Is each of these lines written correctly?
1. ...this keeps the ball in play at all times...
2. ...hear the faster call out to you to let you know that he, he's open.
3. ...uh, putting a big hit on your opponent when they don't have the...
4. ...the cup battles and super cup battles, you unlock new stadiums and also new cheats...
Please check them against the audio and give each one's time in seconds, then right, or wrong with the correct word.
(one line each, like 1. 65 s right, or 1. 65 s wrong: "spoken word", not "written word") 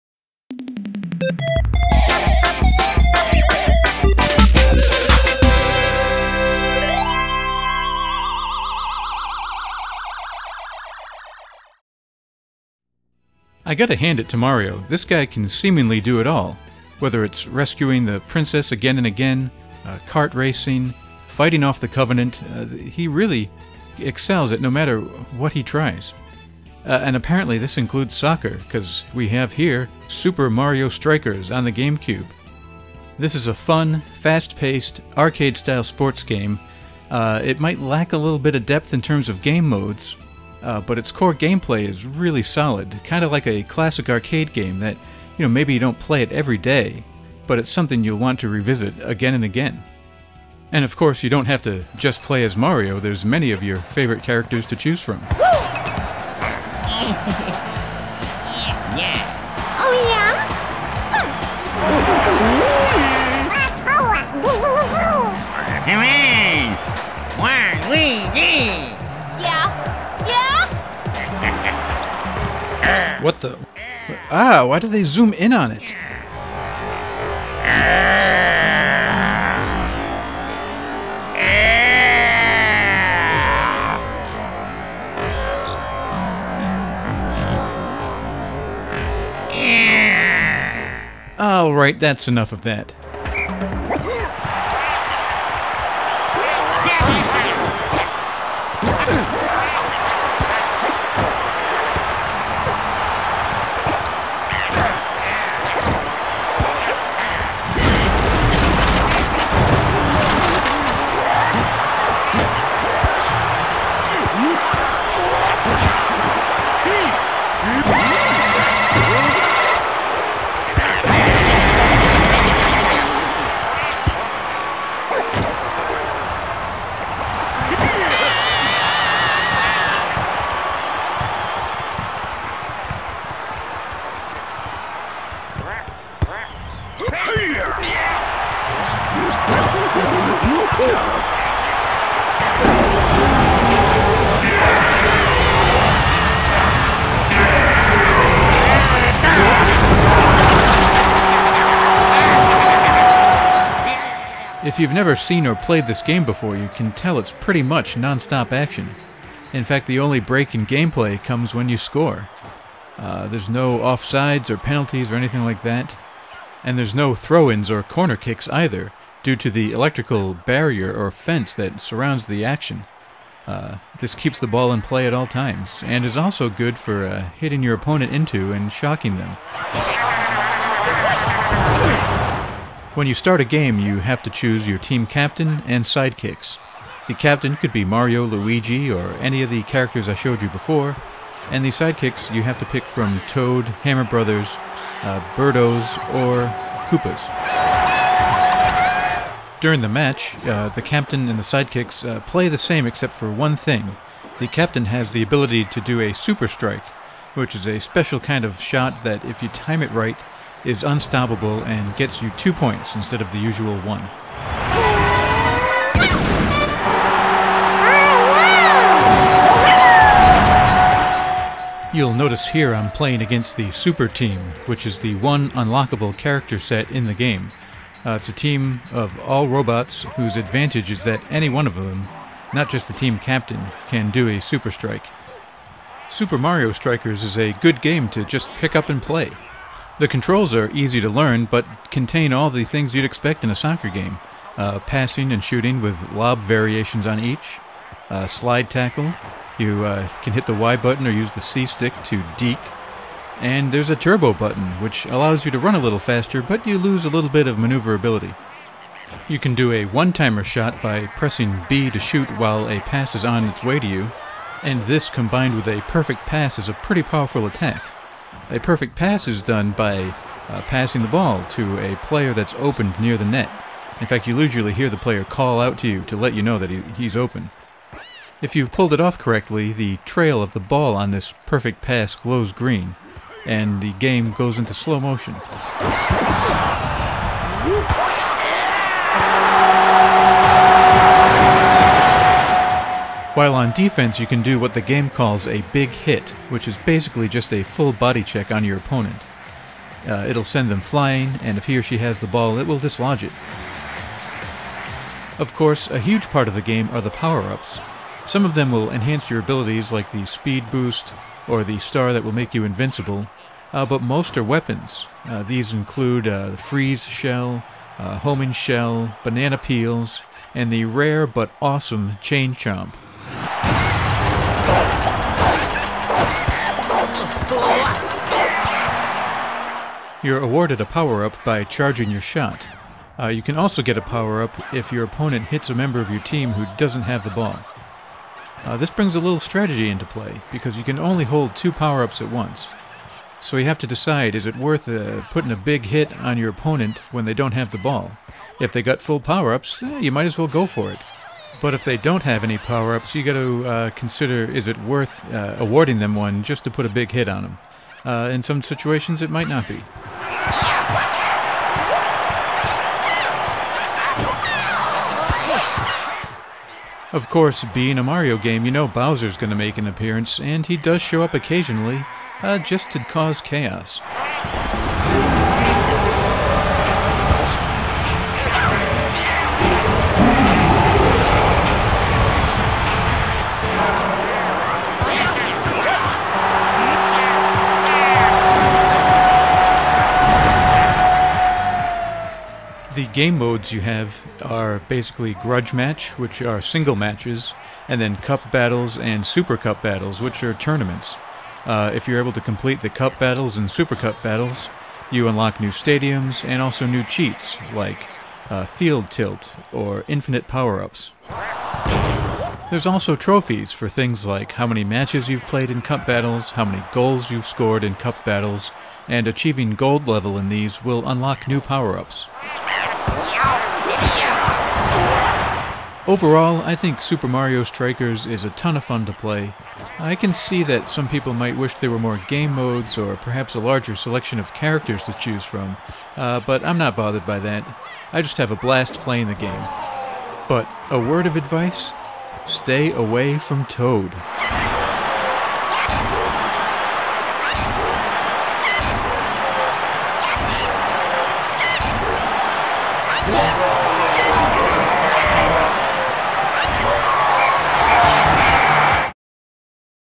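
1. 173 s right
2. 274 s wrong: "player", not "faster"
3. 344 s right
4. 402 s right.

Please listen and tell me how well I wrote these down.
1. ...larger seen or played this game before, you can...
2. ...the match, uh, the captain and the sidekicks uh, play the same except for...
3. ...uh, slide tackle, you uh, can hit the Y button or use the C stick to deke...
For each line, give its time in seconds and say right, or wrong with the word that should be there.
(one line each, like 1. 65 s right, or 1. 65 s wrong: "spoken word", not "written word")
1. 154 s wrong: "never", not "larger"
2. 199 s right
3. 248 s right.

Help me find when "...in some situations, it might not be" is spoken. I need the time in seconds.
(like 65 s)
358 s.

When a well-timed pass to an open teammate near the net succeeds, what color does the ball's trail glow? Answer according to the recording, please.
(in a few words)
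green.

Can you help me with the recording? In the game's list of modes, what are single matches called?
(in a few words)
grudge match.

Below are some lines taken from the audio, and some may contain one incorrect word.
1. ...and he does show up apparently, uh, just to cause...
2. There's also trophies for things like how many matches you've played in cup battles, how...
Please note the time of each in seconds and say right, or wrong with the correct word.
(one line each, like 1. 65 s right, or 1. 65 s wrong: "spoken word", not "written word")
1. 370 s wrong: "occasionally", not "apparently"
2. 412 s right.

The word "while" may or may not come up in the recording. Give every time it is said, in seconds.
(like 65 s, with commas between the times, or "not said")
262 s, 293 s.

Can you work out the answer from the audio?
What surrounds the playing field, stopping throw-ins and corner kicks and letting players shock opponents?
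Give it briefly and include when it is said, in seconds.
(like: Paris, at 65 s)
electrical barrier, at 169 s.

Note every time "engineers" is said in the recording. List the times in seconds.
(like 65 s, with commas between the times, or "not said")
not said.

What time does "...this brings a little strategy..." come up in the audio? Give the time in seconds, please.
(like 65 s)
338 s.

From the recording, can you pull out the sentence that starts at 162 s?
Uh, there's no offsides or penalties or anything like that.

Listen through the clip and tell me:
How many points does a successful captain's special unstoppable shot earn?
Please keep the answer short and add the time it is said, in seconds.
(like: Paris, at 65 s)
2, at 212 s.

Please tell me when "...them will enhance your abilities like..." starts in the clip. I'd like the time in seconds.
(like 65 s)
308 s.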